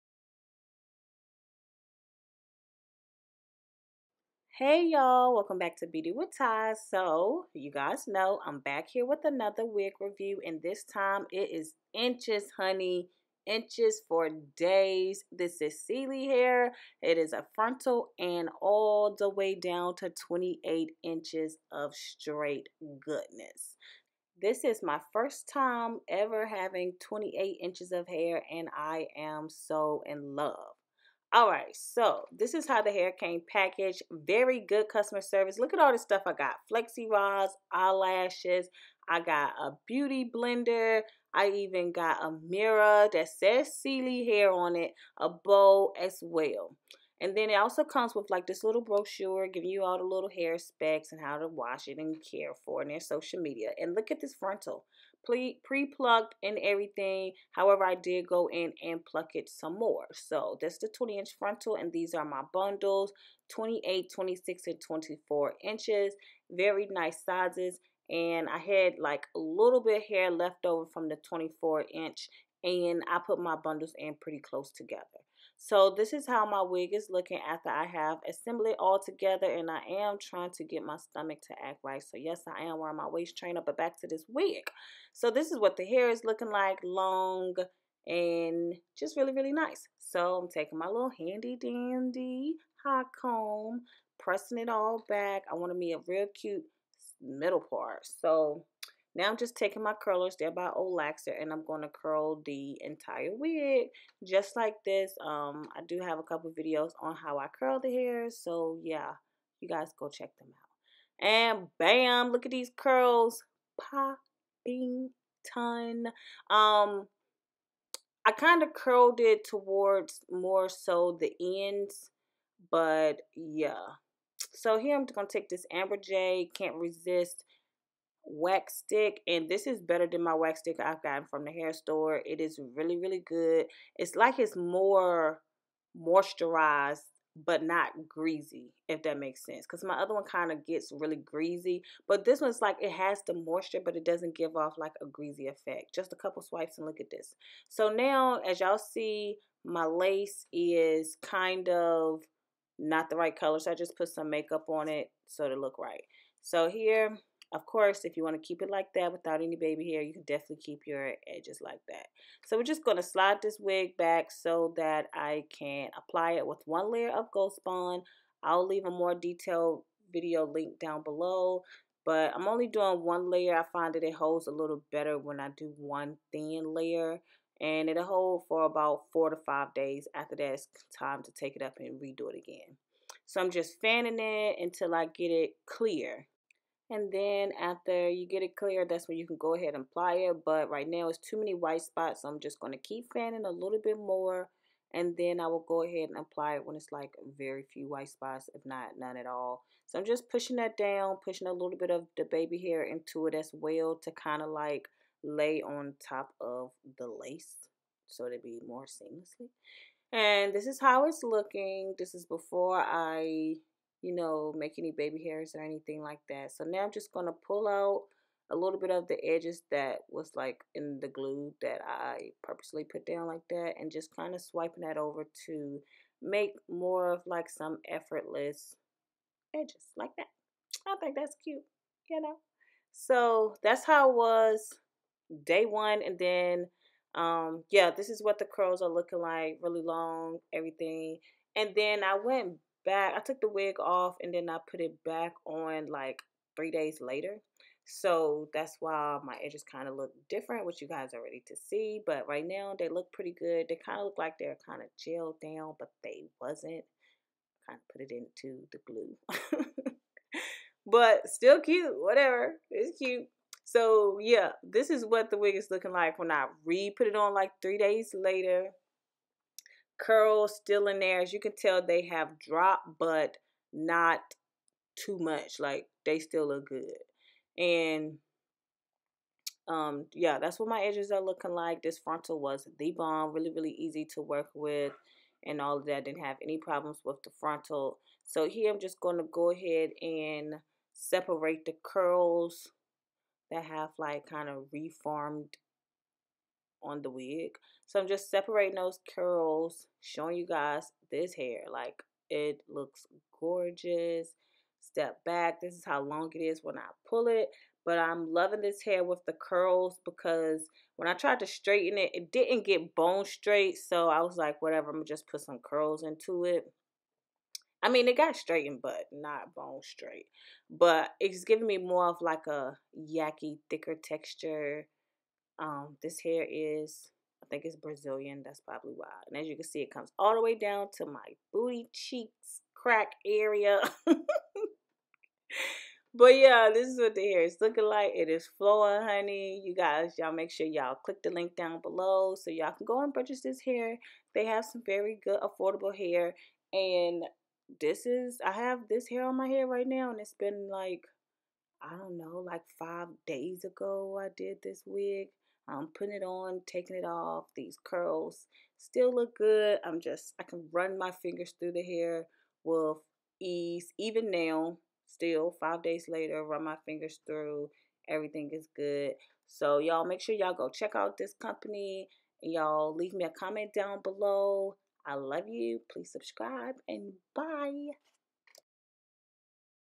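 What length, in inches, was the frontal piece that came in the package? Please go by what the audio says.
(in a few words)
20 inches.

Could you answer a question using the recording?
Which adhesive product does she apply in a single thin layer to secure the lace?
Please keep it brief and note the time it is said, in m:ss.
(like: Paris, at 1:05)
Ghost Bond, at 2:47.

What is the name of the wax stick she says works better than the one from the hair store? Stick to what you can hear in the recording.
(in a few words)
Amber Jay Can't Resist.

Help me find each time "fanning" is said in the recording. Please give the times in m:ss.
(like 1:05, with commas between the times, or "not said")
3:03, 3:13.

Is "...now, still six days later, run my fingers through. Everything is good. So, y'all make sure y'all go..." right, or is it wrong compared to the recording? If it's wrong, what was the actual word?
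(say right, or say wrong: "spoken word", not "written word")
wrong: "five", not "six".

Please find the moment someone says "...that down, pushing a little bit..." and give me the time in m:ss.
3:20.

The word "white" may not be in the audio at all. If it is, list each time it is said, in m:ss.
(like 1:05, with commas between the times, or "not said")
3:11, 3:17.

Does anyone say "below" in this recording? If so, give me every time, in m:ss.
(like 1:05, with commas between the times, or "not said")
2:51, 5:41, 6:14.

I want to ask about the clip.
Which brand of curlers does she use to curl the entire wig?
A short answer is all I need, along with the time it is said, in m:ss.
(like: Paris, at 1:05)
Olaxer, at 1:40.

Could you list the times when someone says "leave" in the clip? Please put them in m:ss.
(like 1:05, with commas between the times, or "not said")
2:48, 6:12.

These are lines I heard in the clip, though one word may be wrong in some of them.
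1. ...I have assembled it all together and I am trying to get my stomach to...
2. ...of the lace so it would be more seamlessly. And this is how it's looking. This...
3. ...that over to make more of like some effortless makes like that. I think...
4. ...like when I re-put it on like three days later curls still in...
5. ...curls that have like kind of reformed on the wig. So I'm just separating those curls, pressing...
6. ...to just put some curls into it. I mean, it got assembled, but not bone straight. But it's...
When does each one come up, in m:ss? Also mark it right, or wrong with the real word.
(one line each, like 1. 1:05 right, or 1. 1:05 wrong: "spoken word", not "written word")
1. 1:17 right
2. 3:26 right
3. 3:44 wrong: "edges", not "makes"
4. 4:25 right
5. 4:51 wrong: "showing", not "pressing"
6. 5:15 wrong: "straightened", not "assembled".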